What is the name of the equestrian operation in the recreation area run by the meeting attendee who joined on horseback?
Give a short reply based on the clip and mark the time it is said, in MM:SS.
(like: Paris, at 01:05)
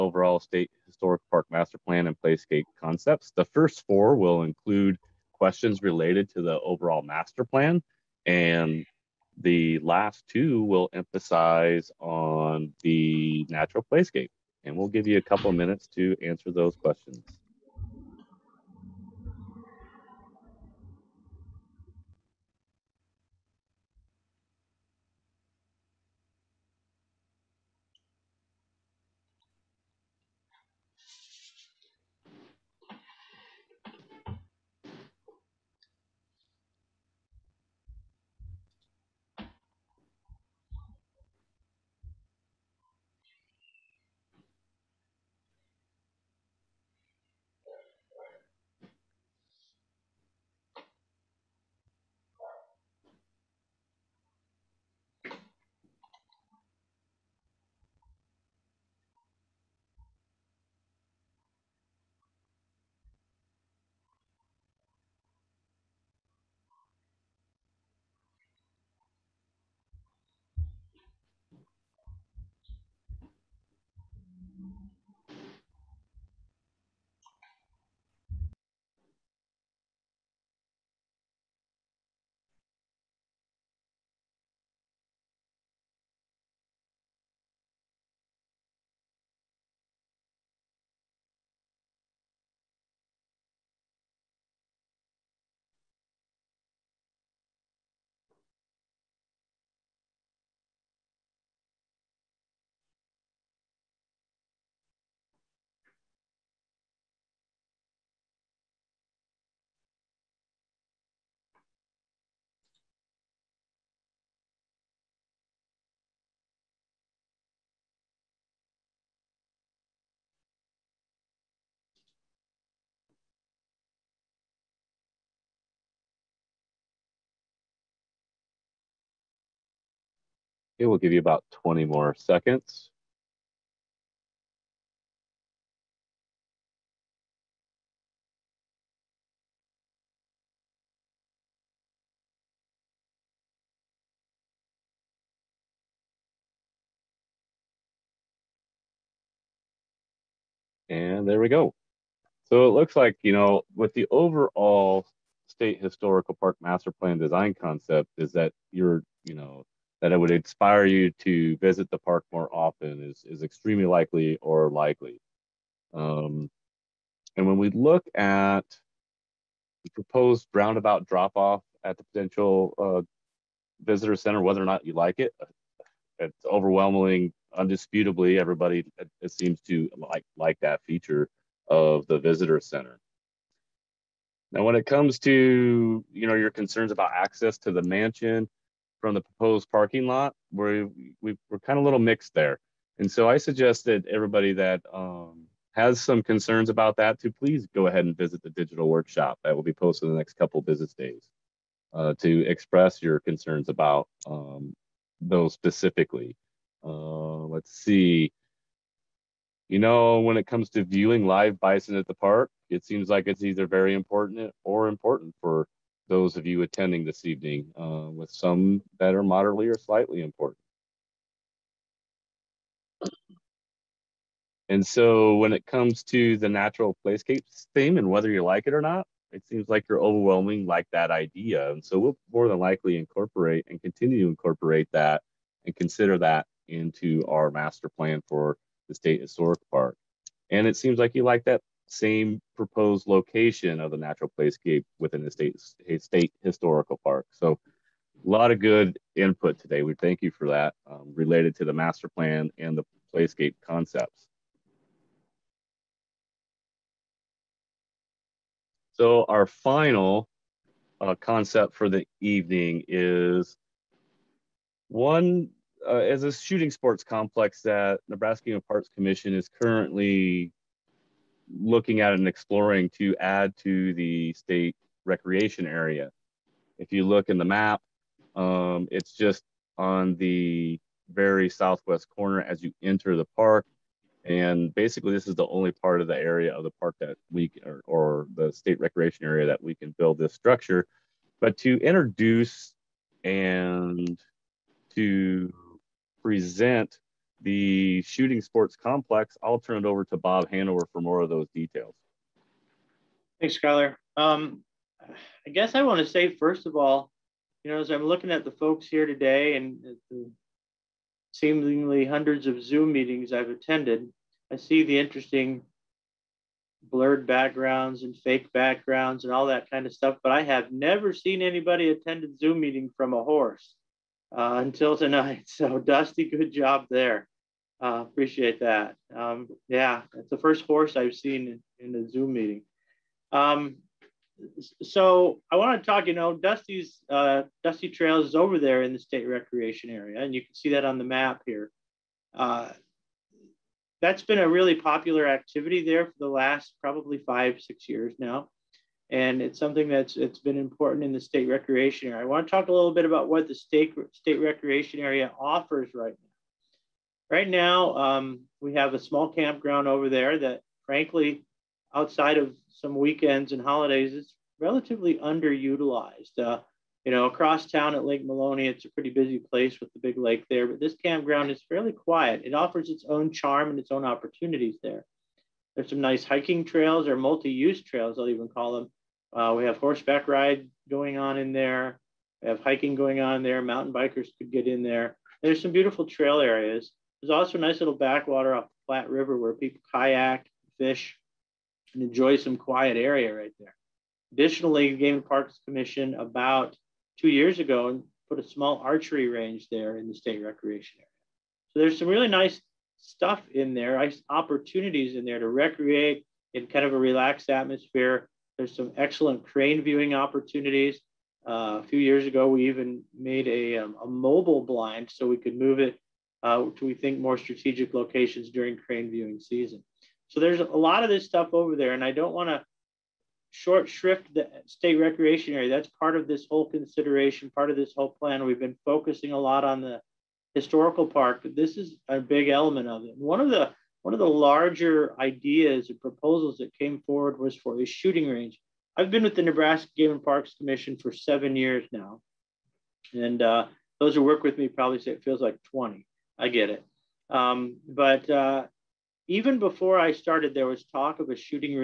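Dusty Trails, at 05:37.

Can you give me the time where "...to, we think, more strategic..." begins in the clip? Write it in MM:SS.
06:56.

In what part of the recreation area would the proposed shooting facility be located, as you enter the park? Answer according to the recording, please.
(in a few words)
Southwest corner.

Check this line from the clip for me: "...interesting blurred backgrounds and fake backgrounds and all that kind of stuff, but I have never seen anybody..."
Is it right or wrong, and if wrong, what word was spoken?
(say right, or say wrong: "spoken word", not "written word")
right.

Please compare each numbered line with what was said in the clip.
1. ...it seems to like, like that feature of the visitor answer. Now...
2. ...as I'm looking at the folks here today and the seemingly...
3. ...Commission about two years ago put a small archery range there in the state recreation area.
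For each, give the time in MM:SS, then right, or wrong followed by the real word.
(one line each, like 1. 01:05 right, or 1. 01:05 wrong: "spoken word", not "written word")
1. 02:59 wrong: "center", not "answer"
2. 05:07 right
3. 06:35 right.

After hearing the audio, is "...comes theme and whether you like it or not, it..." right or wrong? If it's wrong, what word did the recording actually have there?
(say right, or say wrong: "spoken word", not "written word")
wrong: "playscapes", not "comes".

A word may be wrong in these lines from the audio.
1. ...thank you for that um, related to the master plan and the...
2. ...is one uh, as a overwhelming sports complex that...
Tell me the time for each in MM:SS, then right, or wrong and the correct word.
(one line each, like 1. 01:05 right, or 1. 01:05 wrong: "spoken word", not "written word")
1. 04:09 right
2. 04:22 wrong: "shooting", not "overwhelming".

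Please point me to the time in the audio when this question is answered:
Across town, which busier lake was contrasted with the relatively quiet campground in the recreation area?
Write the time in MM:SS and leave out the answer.
06:08.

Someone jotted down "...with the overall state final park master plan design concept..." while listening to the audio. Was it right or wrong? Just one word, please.
wrong.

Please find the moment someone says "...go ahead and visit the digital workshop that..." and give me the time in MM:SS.
03:17.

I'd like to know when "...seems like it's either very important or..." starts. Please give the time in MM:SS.
03:32.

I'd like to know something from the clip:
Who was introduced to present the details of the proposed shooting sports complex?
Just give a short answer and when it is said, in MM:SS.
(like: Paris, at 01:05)
Bob Hanover, at 05:00.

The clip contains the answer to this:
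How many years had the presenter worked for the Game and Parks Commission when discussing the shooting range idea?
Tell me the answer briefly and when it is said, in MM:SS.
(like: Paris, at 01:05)
7, at 07:21.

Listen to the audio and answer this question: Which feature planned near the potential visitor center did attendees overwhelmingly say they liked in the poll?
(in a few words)
Roundabout drop off.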